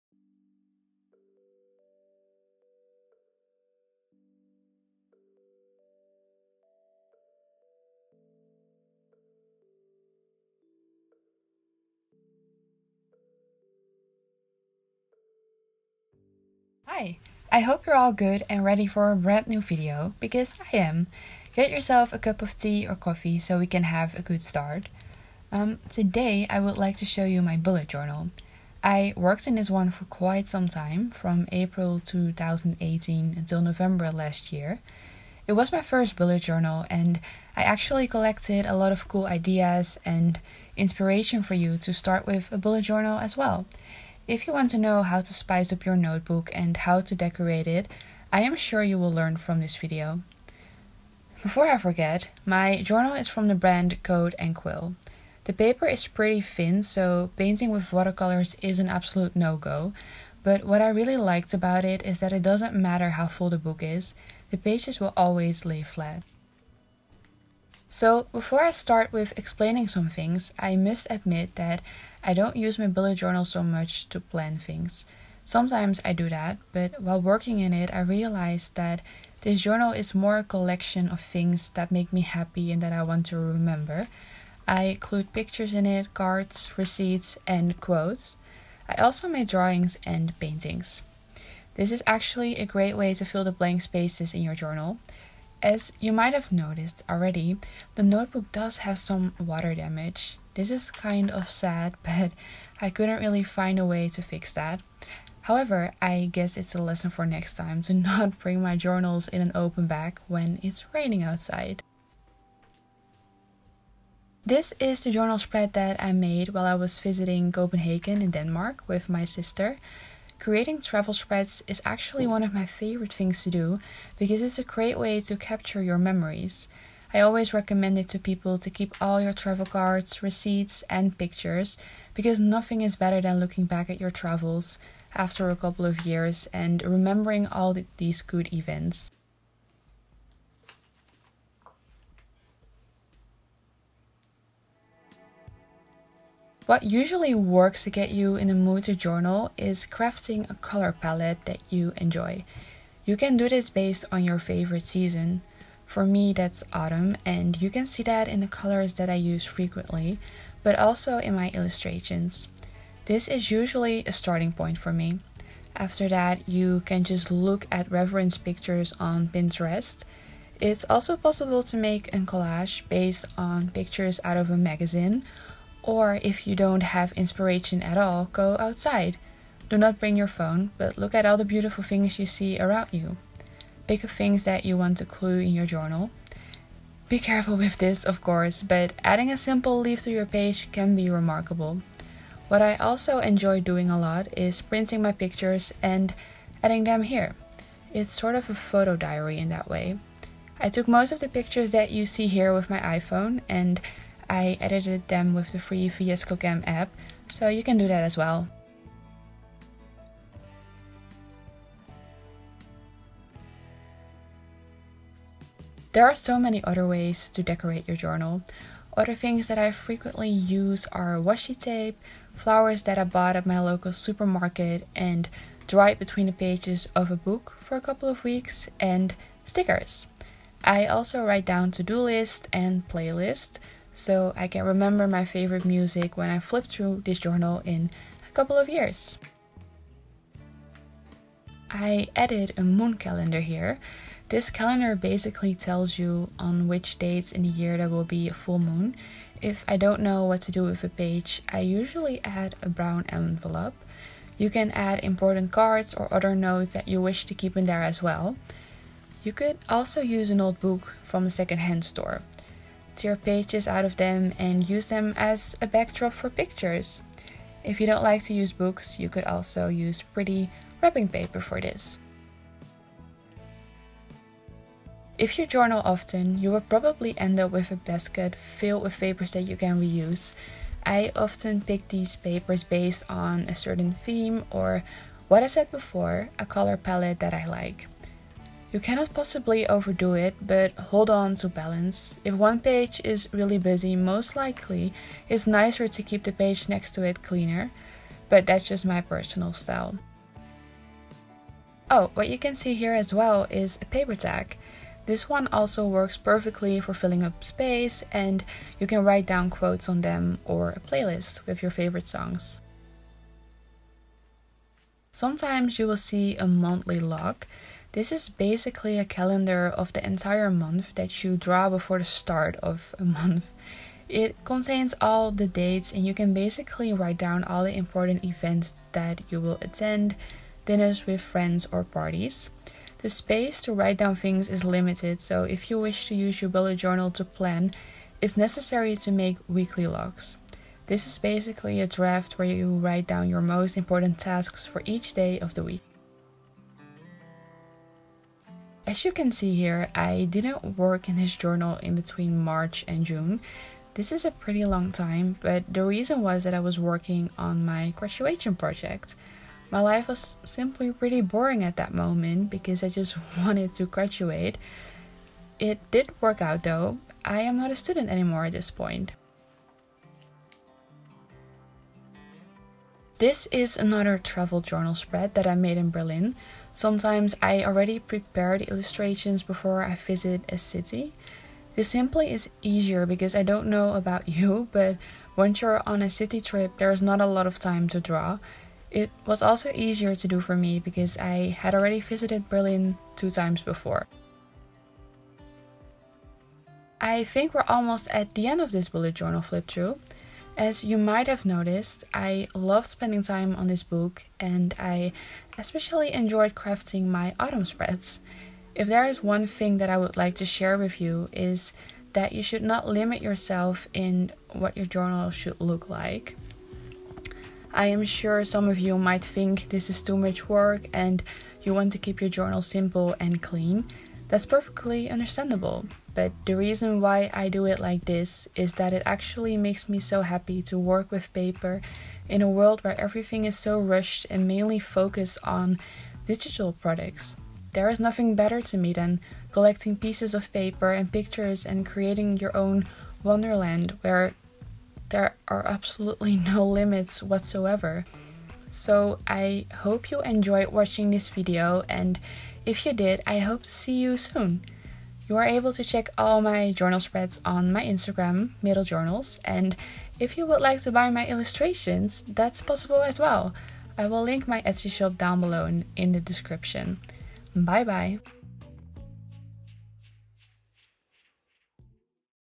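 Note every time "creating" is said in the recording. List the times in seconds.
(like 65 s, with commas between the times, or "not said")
120 s, 441 s.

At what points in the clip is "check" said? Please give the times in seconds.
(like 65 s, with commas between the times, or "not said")
455 s.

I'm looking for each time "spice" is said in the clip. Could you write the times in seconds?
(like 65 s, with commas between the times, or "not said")
45 s.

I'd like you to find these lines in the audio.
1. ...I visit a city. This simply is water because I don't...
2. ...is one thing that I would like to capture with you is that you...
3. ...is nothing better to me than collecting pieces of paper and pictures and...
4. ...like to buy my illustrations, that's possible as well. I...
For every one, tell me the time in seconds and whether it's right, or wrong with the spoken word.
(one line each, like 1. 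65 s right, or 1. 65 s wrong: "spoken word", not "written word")
1. 379 s wrong: "easier", not "water"
2. 409 s wrong: "share", not "capture"
3. 437 s right
4. 460 s right.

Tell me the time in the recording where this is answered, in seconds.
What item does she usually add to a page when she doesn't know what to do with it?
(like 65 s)
252 s.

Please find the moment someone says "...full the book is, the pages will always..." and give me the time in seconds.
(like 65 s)
63 s.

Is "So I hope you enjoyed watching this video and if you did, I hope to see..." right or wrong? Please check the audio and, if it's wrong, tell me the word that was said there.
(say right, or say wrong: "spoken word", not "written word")
right.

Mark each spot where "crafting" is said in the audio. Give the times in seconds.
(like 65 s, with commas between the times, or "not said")
149 s, 406 s.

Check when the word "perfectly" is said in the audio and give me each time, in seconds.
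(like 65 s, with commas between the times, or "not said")
306 s, 424 s.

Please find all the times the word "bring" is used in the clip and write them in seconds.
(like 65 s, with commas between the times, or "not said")
108 s, 179 s.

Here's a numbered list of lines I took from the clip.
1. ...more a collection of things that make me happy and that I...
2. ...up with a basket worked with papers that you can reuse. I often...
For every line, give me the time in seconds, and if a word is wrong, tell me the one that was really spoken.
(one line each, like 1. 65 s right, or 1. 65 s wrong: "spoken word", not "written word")
1. 80 s right
2. 277 s wrong: "filled", not "worked".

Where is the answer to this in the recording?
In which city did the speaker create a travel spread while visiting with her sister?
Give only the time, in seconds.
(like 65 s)
117 s.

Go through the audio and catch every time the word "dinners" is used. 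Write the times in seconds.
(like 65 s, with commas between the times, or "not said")
330 s.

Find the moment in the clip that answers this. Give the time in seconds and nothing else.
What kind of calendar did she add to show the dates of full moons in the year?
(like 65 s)
242 s.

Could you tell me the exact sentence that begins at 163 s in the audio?
This is usually a starting point for me.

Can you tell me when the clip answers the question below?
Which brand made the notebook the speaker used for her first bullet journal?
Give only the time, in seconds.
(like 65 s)
54 s.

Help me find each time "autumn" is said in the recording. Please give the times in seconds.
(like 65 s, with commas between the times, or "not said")
156 s, 407 s.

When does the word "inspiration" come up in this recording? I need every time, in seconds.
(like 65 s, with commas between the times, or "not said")
40 s, 177 s.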